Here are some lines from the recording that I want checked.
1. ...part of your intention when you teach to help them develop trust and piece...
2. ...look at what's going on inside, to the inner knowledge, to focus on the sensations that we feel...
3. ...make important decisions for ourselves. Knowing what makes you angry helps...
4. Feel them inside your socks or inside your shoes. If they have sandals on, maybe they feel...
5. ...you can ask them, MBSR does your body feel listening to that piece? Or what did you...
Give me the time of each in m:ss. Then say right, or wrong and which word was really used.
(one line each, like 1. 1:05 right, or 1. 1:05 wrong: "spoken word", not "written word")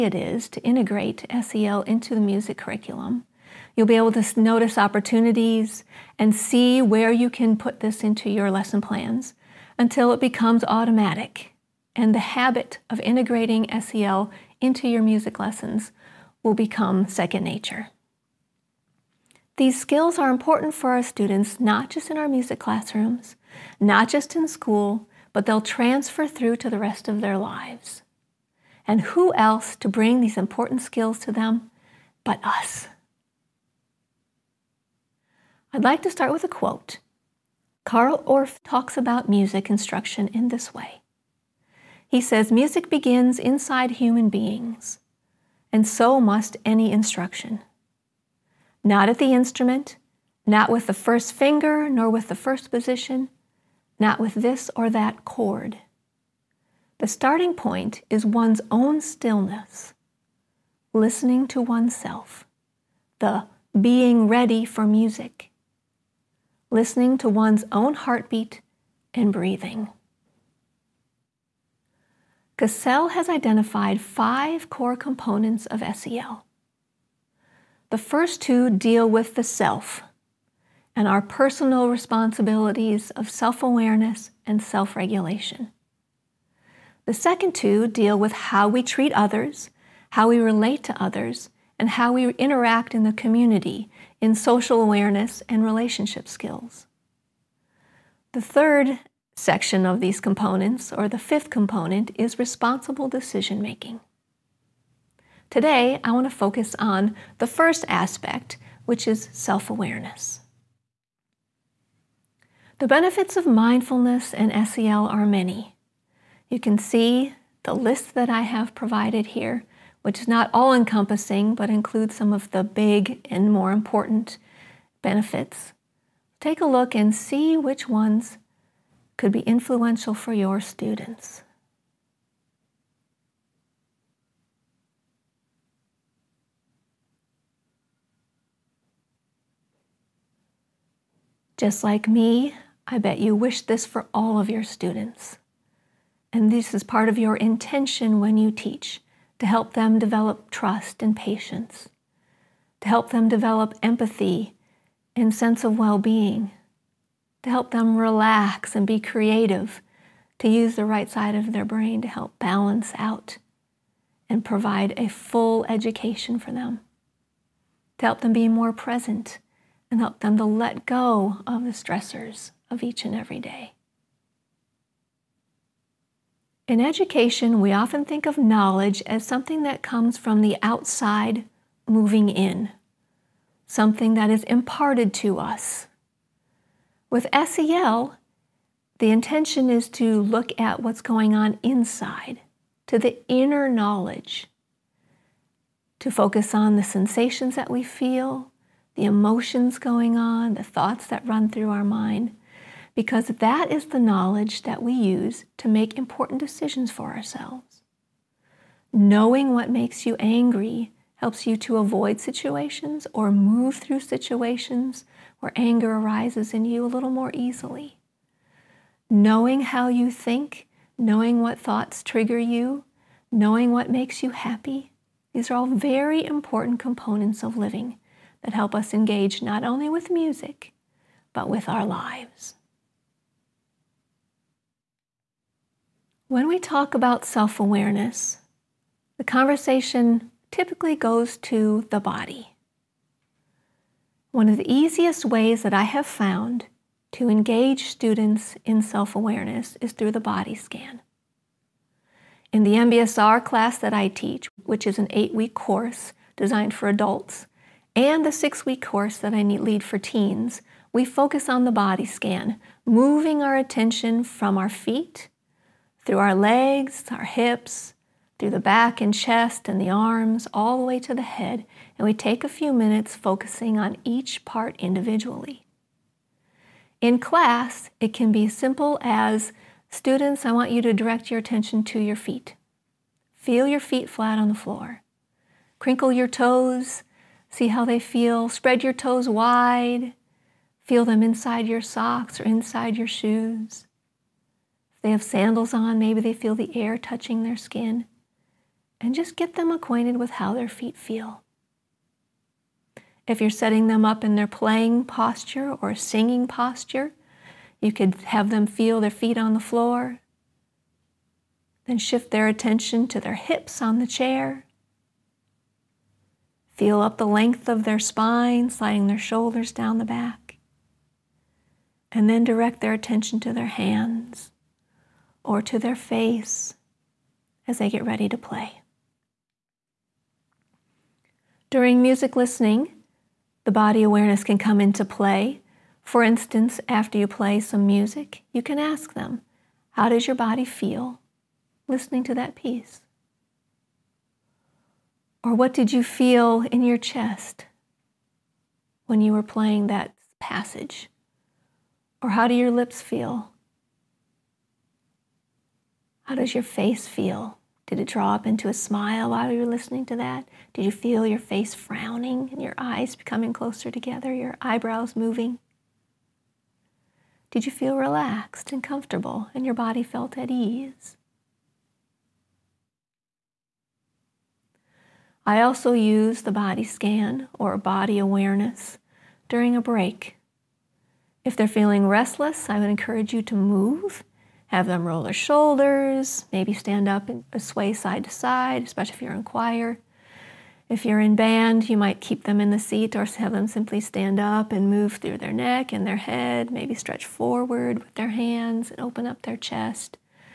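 1. 2:26 wrong: "patience", not "piece"
2. 3:10 right
3. 3:25 right
4. 4:50 right
5. 5:38 wrong: "How", not "MBSR".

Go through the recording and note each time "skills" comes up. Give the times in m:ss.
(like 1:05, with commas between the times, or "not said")
0:19, 0:30, 1:36.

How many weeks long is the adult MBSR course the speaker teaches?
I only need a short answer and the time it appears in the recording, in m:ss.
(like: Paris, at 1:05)
8 weeks, at 4:15.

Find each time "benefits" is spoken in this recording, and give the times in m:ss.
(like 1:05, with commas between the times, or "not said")
1:52, 2:05.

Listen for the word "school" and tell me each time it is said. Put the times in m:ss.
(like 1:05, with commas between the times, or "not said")
0:24.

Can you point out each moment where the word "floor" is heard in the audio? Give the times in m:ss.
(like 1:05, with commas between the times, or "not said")
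4:44, 5:09.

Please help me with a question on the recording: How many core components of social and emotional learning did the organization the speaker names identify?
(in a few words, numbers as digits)
5.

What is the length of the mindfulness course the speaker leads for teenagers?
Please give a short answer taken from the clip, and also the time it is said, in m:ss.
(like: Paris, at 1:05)
6 weeks, at 4:18.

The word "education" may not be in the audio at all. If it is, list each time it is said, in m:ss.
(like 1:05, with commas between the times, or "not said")
2:45, 2:56.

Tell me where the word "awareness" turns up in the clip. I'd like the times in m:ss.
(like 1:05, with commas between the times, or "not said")
1:23, 1:34, 1:49, 3:57, 4:09, 5:34, 6:18.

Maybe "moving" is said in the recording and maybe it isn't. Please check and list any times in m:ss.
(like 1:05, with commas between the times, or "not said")
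3:01, 4:22, 6:05.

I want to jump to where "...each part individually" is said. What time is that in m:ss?
4:34.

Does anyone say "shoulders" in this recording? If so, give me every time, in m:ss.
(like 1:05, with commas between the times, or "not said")
5:19, 6:25.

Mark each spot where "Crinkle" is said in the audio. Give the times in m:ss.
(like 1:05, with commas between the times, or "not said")
4:45.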